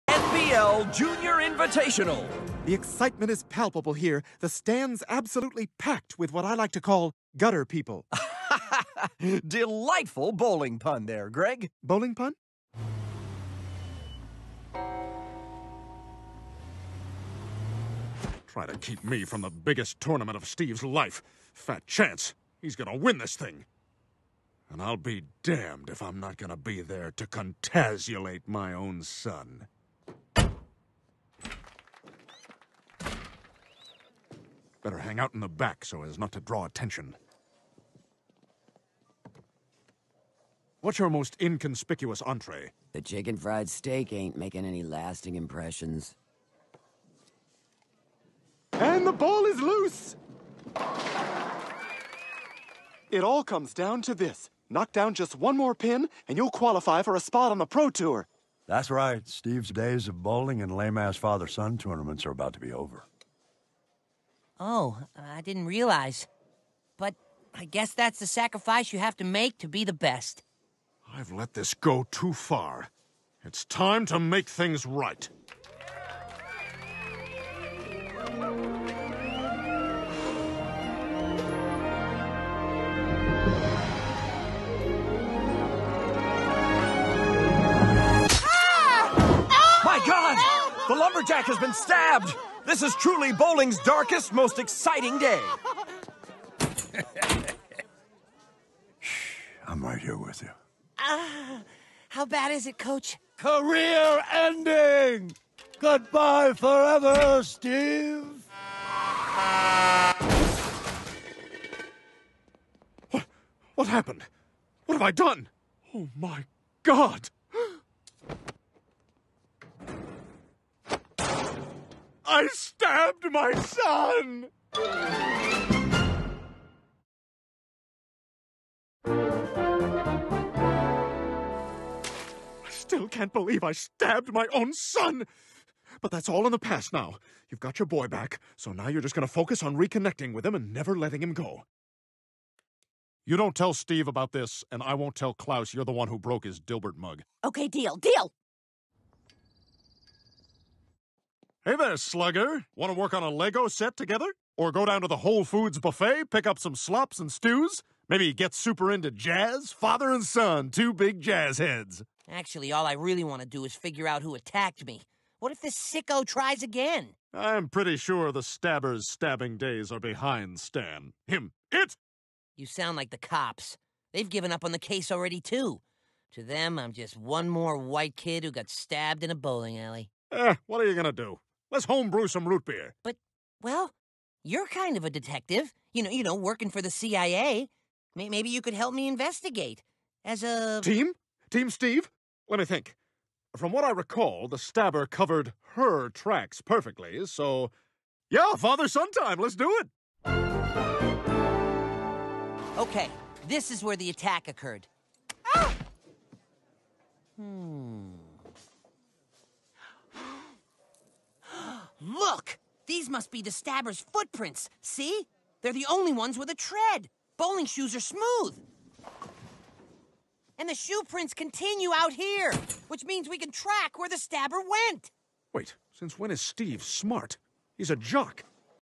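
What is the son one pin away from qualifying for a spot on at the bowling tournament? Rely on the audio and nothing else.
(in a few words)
Pro Tour.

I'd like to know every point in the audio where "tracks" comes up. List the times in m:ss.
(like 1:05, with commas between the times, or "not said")
3:16, 3:43.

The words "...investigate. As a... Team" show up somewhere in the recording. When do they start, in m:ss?
3:09.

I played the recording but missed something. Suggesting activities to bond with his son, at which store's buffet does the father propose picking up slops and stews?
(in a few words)
Whole Foods.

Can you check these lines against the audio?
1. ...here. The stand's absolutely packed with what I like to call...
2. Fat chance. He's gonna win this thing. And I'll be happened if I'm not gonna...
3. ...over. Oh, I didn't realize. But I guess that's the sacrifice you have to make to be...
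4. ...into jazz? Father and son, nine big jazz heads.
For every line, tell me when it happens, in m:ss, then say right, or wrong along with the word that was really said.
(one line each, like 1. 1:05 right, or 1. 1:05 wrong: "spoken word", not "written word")
1. 0:03 right
2. 0:21 wrong: "damned", not "happened"
3. 1:02 right
4. 2:38 wrong: "two", not "nine".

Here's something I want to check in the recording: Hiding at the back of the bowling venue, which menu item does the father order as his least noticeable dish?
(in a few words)
Chicken fried steak.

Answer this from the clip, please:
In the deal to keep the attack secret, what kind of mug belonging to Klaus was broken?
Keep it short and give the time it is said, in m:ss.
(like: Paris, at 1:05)
Dilbert mug, at 2:26.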